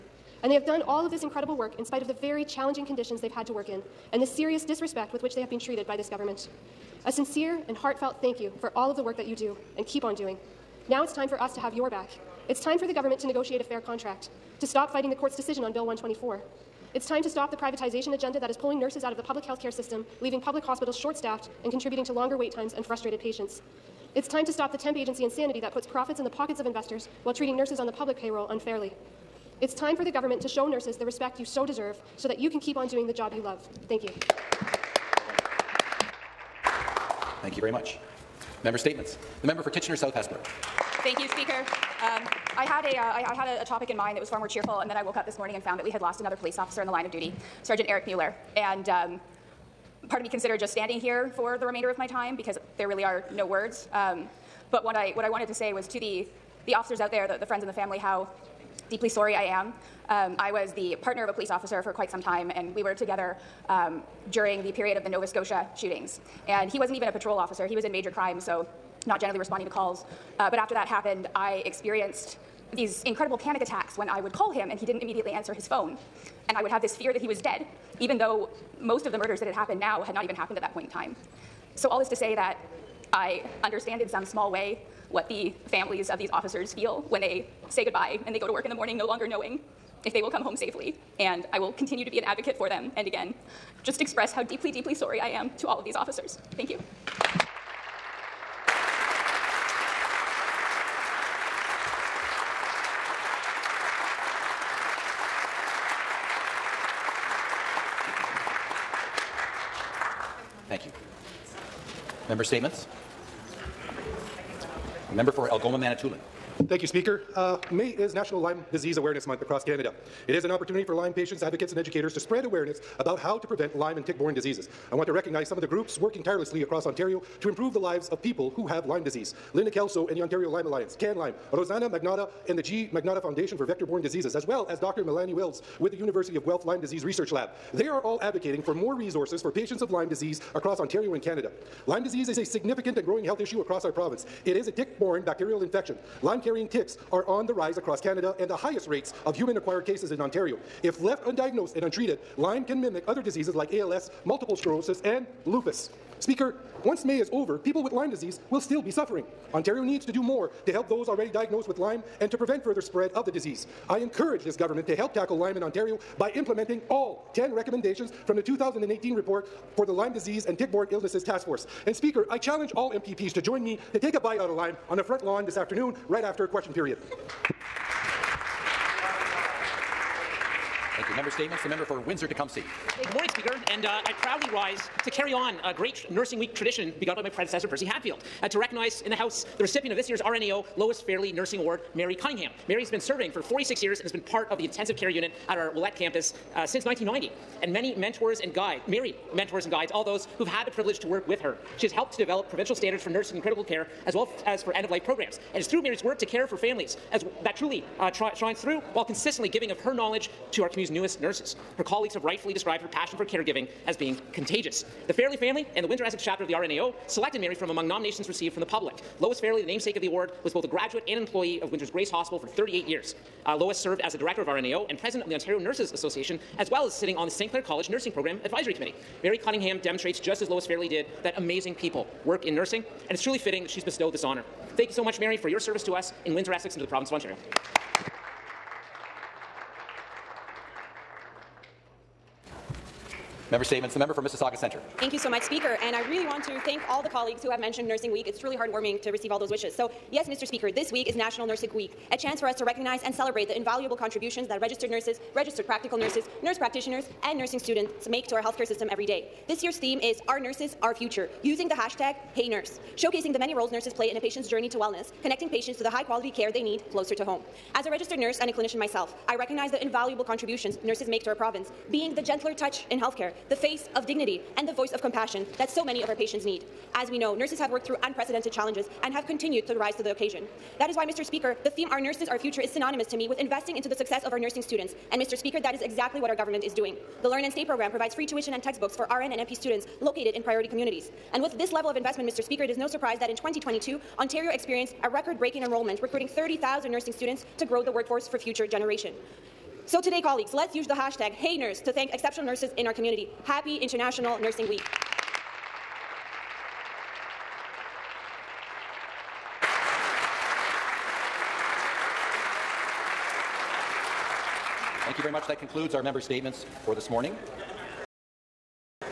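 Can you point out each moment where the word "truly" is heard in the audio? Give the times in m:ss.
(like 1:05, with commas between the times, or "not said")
3:27, 3:53, 4:08.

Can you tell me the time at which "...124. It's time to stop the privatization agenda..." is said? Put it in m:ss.
0:15.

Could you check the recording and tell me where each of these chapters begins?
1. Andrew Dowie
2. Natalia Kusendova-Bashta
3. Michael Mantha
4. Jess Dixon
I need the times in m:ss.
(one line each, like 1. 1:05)
1. 3:00
2. 4:00
3. 1:51
4. 0:38.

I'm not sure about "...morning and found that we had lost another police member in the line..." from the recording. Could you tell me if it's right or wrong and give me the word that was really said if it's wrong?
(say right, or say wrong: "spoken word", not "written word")
wrong: "officer", not "member".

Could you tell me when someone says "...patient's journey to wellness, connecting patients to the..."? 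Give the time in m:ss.
4:24.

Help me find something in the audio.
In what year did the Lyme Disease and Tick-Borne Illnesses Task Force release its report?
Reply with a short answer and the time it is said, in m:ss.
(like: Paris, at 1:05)
2018, at 2:48.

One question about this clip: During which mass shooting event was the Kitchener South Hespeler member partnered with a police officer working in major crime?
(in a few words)
Nova Scotia shootings.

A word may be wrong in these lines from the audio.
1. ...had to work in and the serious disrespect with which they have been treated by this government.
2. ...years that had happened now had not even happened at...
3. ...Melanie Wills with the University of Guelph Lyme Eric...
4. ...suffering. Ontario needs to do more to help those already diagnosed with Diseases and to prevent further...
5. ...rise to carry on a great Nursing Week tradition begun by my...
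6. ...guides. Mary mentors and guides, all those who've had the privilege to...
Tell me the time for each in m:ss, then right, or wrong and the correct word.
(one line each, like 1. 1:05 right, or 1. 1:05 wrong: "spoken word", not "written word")
1. 0:03 right
2. 1:19 wrong: "murders", not "years"
3. 2:15 wrong: "Disease", not "Eric"
4. 2:38 wrong: "Lyme", not "Diseases"
5. 3:04 right
6. 3:18 right.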